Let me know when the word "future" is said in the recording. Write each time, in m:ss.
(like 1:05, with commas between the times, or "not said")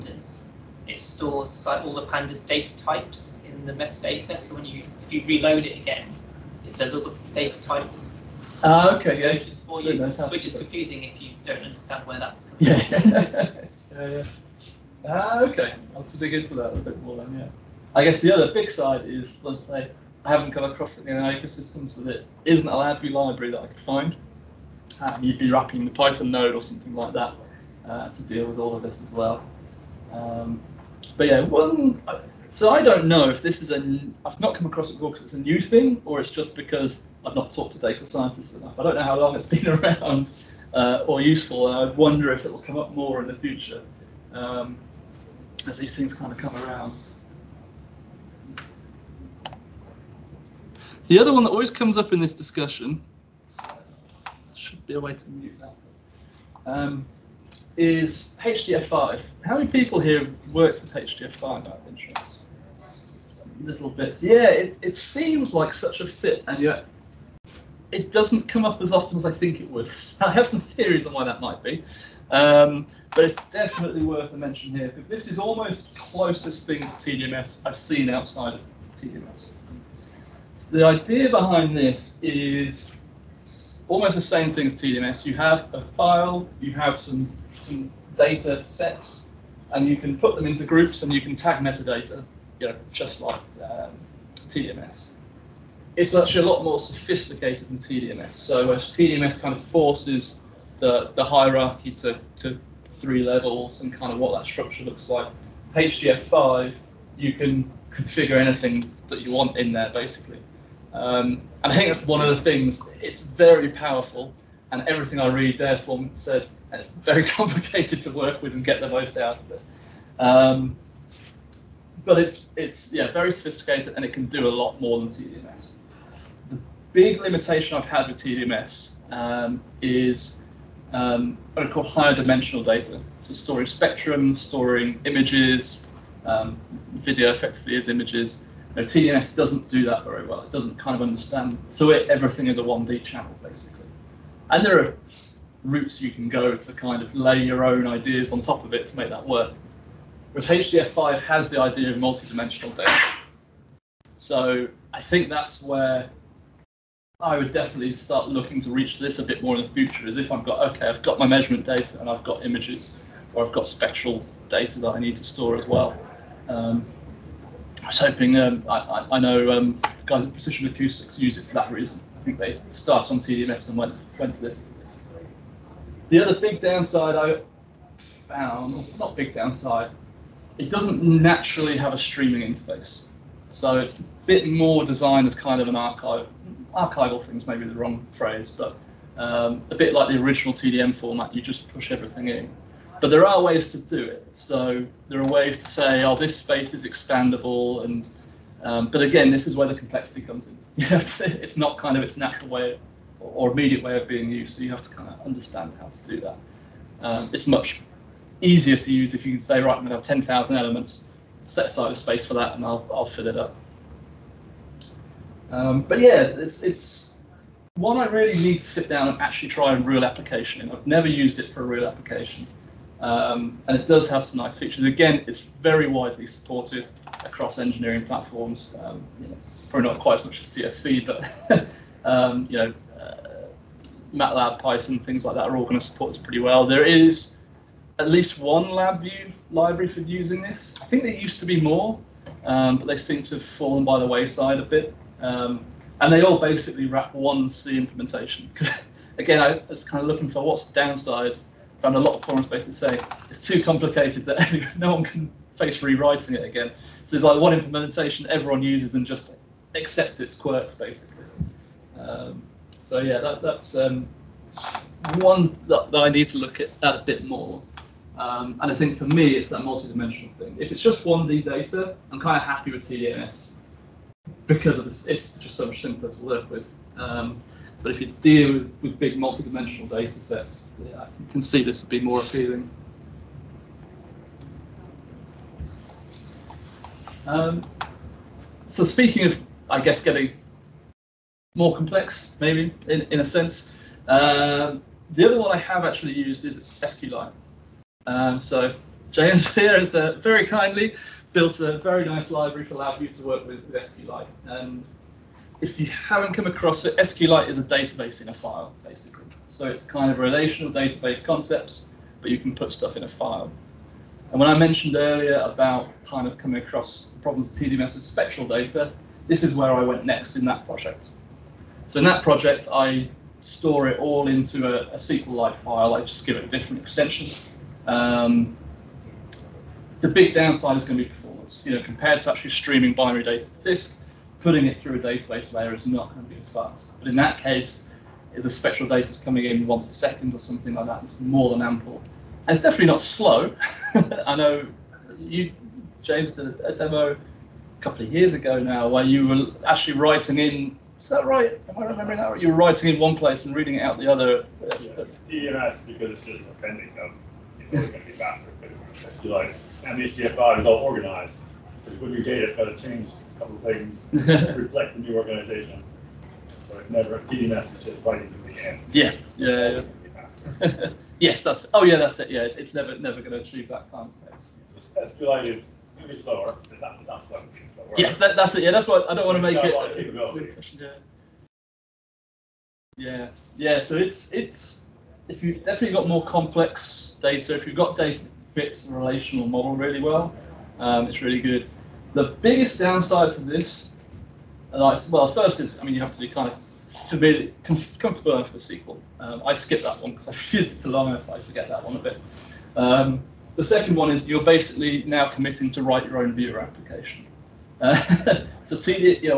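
0:43, 2:39.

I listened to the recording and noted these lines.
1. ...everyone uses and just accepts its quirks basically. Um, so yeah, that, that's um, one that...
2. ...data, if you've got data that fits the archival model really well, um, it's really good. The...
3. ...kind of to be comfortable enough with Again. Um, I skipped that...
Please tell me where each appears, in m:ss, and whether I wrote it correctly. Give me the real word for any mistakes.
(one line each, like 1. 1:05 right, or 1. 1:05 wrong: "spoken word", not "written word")
1. 4:18 right
2. 6:27 wrong: "relational", not "archival"
3. 6:36 wrong: "SQL", not "Again".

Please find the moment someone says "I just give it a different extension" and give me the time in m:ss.
5:25.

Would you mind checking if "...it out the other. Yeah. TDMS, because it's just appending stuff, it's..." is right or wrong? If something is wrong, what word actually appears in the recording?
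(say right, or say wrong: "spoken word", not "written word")
right.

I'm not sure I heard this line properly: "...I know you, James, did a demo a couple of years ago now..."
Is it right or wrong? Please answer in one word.
right.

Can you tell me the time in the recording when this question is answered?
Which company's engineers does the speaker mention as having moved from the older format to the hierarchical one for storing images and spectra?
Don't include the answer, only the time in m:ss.
2:50.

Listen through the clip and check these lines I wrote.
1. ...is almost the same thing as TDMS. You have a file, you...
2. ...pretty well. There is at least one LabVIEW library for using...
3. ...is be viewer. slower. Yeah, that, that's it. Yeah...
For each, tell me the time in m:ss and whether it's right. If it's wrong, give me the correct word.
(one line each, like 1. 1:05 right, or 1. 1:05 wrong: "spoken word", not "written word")
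1. 1:22 right
2. 3:56 right
3. 6:15 wrong: "slower", not "viewer".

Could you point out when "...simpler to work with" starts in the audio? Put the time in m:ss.
4:35.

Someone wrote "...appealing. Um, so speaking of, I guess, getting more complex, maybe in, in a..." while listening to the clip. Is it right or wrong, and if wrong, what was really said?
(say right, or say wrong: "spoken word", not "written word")
right.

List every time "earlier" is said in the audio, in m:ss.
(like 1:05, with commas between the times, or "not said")
5:14.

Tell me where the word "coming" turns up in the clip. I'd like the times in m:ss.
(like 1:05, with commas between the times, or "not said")
0:12, 5:16, 5:39.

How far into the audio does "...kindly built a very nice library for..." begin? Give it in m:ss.
5:00.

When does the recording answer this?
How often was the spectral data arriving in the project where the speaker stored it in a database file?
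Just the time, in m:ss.
5:39.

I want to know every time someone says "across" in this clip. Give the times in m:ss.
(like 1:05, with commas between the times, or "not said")
0:20, 0:34, 3:47, 5:06, 5:16.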